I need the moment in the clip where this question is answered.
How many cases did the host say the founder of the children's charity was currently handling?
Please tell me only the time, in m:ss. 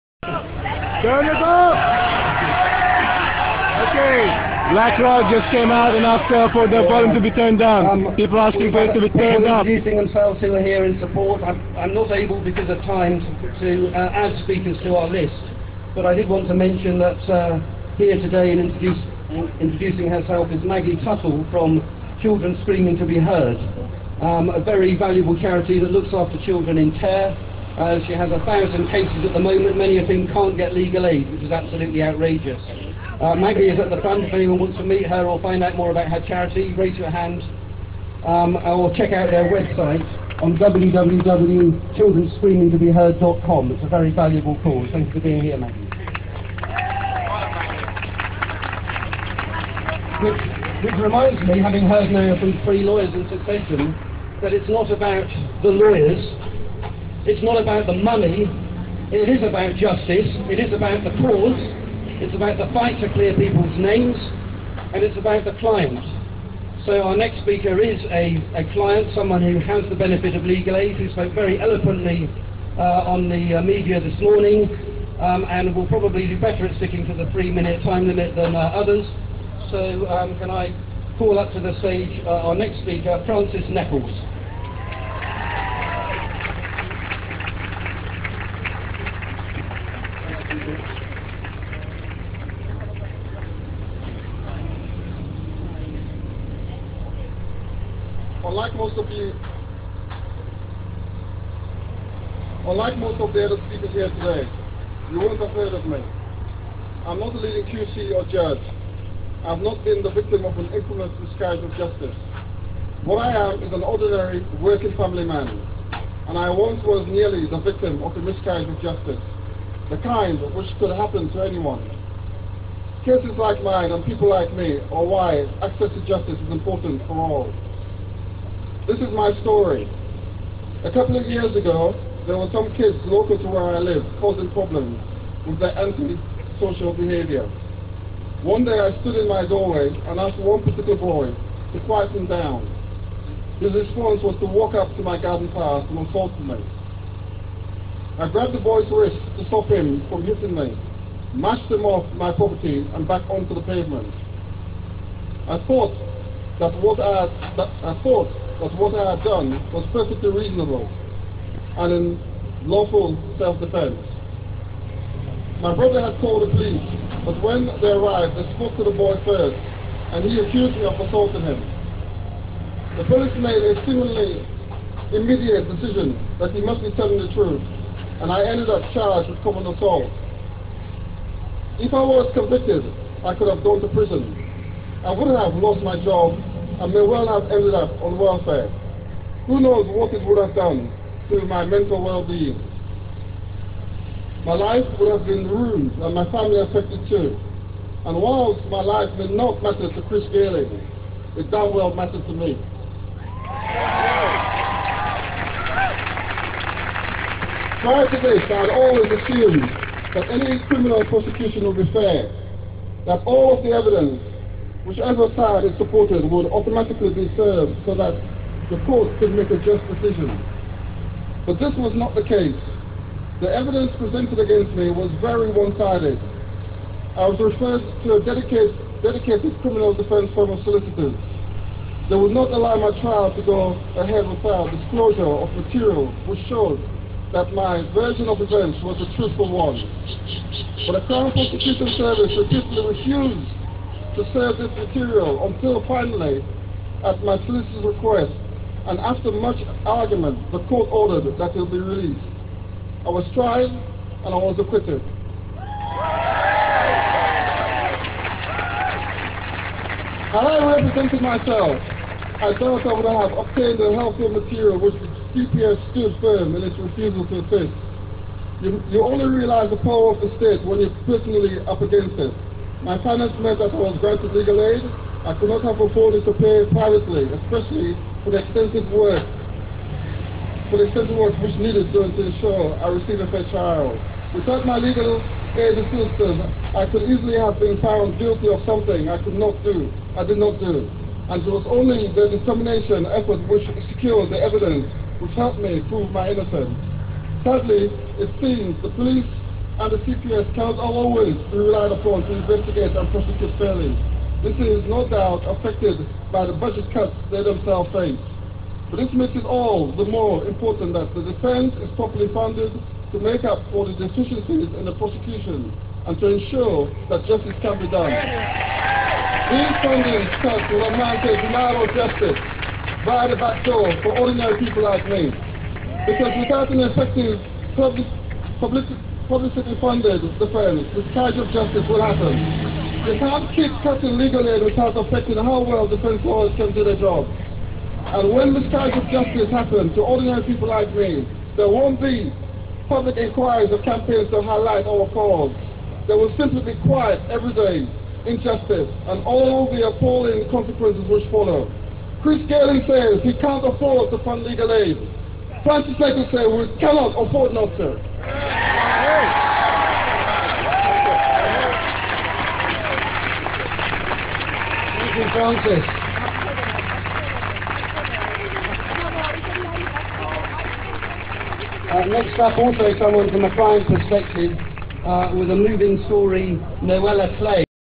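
0:28.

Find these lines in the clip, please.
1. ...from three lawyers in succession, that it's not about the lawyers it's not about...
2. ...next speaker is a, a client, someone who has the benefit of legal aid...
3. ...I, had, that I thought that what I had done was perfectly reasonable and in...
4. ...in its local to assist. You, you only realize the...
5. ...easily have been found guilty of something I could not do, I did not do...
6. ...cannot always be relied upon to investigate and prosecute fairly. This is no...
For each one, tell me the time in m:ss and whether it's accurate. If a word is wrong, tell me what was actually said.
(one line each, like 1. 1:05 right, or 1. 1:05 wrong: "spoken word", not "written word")
1. 0:52 right
2. 1:07 right
3. 2:37 right
4. 4:26 wrong: "refusal", not "local"
5. 4:47 right
6. 5:00 right.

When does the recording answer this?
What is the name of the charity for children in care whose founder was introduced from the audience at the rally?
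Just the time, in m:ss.
0:22.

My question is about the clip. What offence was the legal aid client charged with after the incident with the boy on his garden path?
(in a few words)
common assault.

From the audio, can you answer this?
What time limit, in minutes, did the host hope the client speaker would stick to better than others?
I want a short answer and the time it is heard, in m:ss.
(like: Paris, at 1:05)
3, at 1:17.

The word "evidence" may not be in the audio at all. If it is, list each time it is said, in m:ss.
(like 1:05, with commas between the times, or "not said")
3:33, 3:43, 4:54.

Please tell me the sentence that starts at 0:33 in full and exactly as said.
Uh, Maggie is at the front.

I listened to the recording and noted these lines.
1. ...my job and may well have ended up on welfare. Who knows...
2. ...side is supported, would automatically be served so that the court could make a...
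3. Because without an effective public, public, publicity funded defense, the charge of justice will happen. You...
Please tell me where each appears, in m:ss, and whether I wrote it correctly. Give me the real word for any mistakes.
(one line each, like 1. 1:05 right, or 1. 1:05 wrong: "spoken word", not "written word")
1. 3:05 right
2. 3:35 right
3. 5:26 right.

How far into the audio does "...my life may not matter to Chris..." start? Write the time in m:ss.
3:18.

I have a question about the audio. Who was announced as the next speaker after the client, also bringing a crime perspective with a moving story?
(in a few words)
Noella Clay.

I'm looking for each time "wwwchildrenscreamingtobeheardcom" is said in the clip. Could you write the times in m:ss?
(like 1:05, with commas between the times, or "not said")
0:40.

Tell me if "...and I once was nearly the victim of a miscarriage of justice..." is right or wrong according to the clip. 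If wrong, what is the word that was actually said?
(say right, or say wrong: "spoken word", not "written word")
right.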